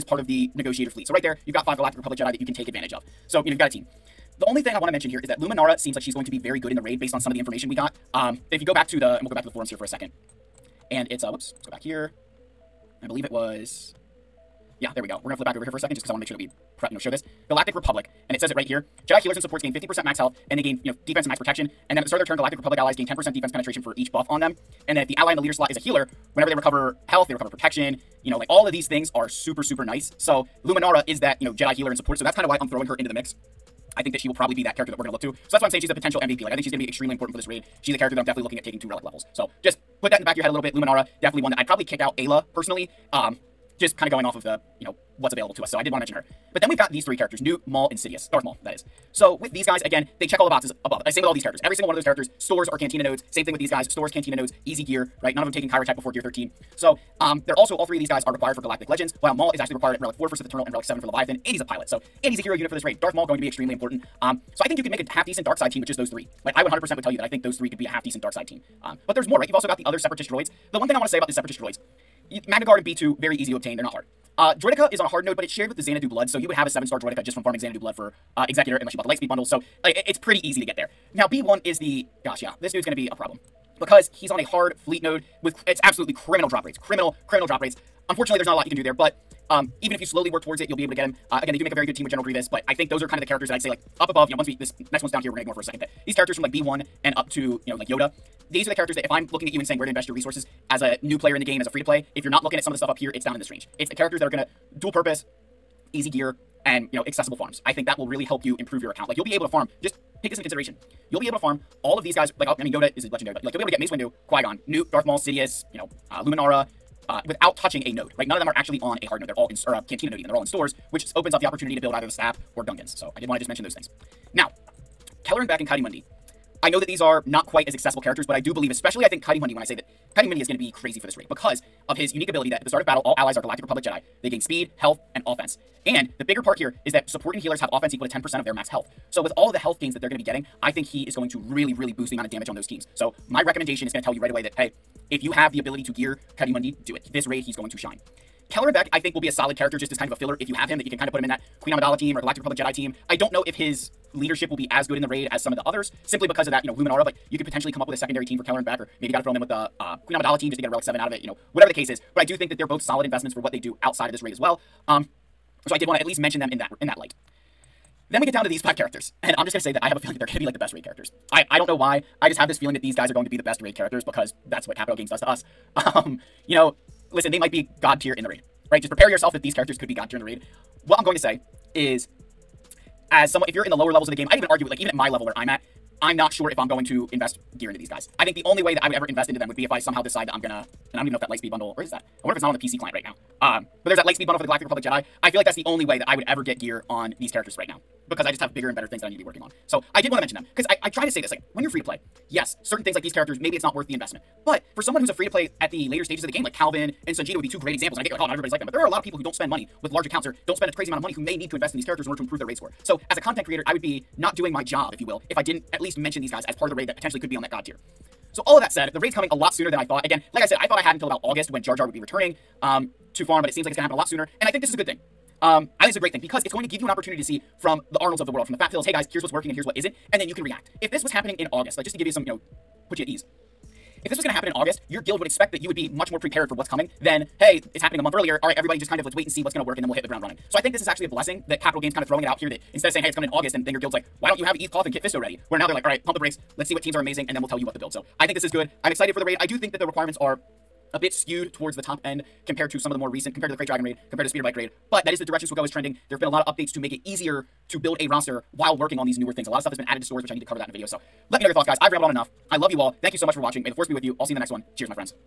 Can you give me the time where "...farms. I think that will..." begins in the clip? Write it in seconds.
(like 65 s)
107 s.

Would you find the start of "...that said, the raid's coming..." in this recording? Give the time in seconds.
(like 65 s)
218 s.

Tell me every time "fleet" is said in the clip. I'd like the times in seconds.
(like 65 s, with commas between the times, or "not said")
0 s, 84 s.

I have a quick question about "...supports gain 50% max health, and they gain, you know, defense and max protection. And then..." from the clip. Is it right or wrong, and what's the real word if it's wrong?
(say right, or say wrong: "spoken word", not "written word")
right.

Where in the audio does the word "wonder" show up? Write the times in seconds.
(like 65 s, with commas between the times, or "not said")
192 s.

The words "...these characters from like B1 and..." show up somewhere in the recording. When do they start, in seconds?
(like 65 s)
96 s.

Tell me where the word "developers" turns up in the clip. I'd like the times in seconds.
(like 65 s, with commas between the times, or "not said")
not said.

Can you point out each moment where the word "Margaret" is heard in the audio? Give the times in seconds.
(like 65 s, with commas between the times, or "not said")
not said.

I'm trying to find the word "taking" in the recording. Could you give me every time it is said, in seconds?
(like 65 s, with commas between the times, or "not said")
38 s, 55 s.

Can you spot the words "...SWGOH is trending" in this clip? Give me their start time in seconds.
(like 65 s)
255 s.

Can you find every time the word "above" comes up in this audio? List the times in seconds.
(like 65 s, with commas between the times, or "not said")
50 s, 94 s.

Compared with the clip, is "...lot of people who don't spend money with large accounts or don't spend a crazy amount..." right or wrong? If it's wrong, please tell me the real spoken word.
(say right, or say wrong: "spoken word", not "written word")
right.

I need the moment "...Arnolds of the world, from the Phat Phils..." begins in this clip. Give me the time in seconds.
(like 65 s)
228 s.